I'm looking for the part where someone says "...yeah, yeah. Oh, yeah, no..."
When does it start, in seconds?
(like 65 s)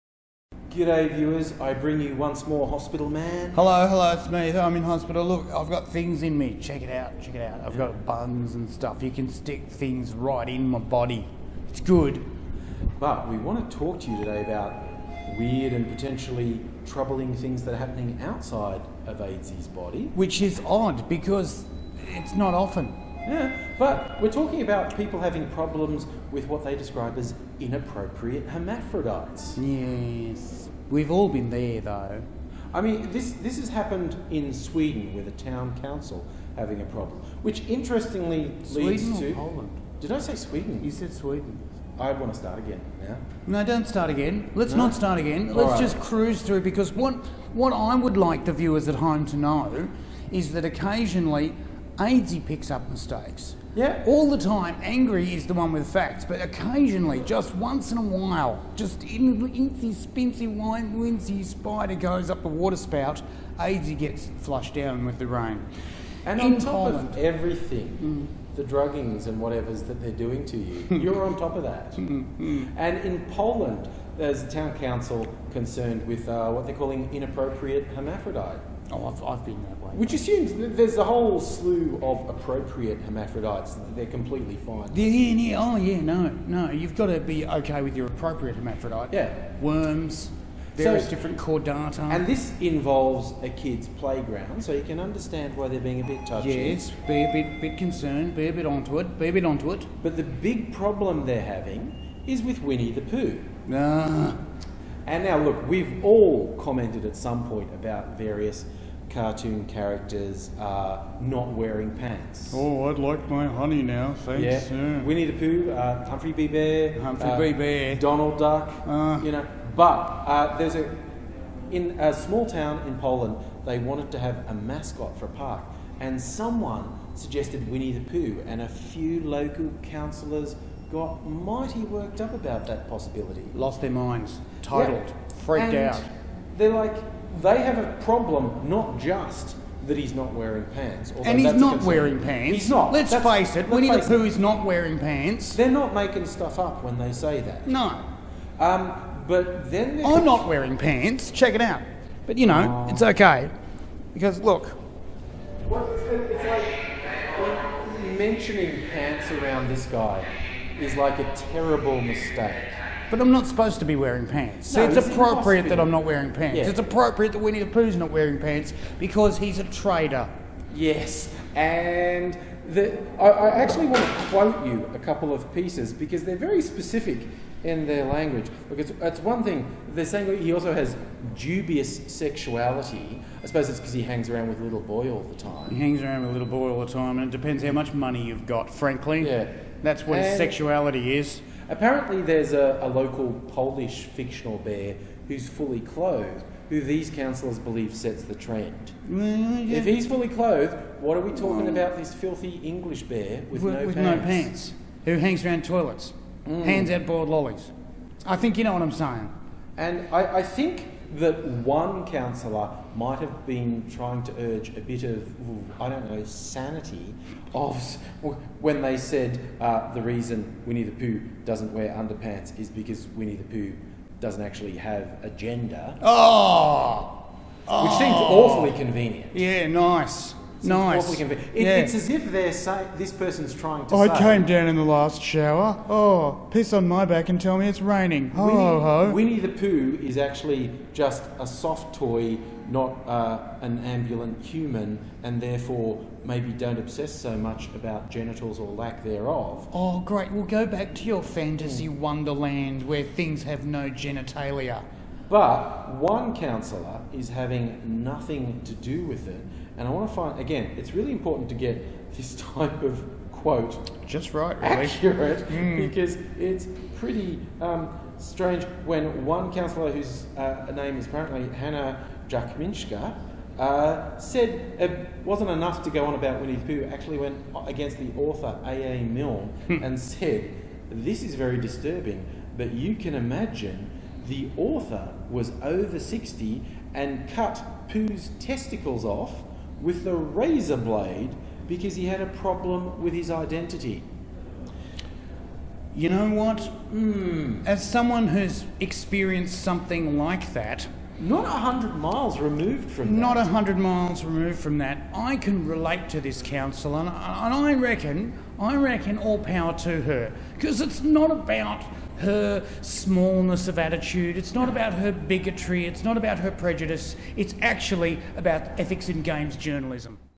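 85 s.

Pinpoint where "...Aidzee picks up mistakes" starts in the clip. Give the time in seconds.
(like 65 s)
52 s.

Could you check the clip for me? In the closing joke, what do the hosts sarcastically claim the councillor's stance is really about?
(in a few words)
ethics in games journalism.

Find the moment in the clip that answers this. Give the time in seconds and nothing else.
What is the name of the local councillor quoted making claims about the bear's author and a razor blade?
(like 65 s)
271 s.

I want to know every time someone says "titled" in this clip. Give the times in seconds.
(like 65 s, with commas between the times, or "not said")
134 s.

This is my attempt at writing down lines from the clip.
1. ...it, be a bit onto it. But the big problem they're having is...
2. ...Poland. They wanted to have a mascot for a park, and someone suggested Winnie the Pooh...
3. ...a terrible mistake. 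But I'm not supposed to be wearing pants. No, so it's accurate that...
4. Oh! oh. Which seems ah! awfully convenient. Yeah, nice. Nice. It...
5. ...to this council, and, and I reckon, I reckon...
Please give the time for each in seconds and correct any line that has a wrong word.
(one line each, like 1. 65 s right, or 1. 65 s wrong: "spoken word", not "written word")
1. 98 s right
2. 122 s right
3. 161 s wrong: "appropriate", not "accurate"
4. 226 s right
5. 306 s right.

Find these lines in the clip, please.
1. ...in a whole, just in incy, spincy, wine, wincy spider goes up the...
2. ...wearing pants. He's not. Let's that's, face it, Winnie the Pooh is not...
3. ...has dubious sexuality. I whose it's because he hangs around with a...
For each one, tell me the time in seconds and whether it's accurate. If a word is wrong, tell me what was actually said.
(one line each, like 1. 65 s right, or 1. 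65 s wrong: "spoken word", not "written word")
1. 57 s wrong: "while", not "whole"
2. 141 s right
3. 180 s wrong: "suppose", not "whose".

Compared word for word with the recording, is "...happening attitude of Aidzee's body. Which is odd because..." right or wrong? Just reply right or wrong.
wrong.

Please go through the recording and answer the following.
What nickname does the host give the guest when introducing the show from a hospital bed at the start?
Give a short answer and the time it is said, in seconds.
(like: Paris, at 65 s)
Hospital Man, at 2 s.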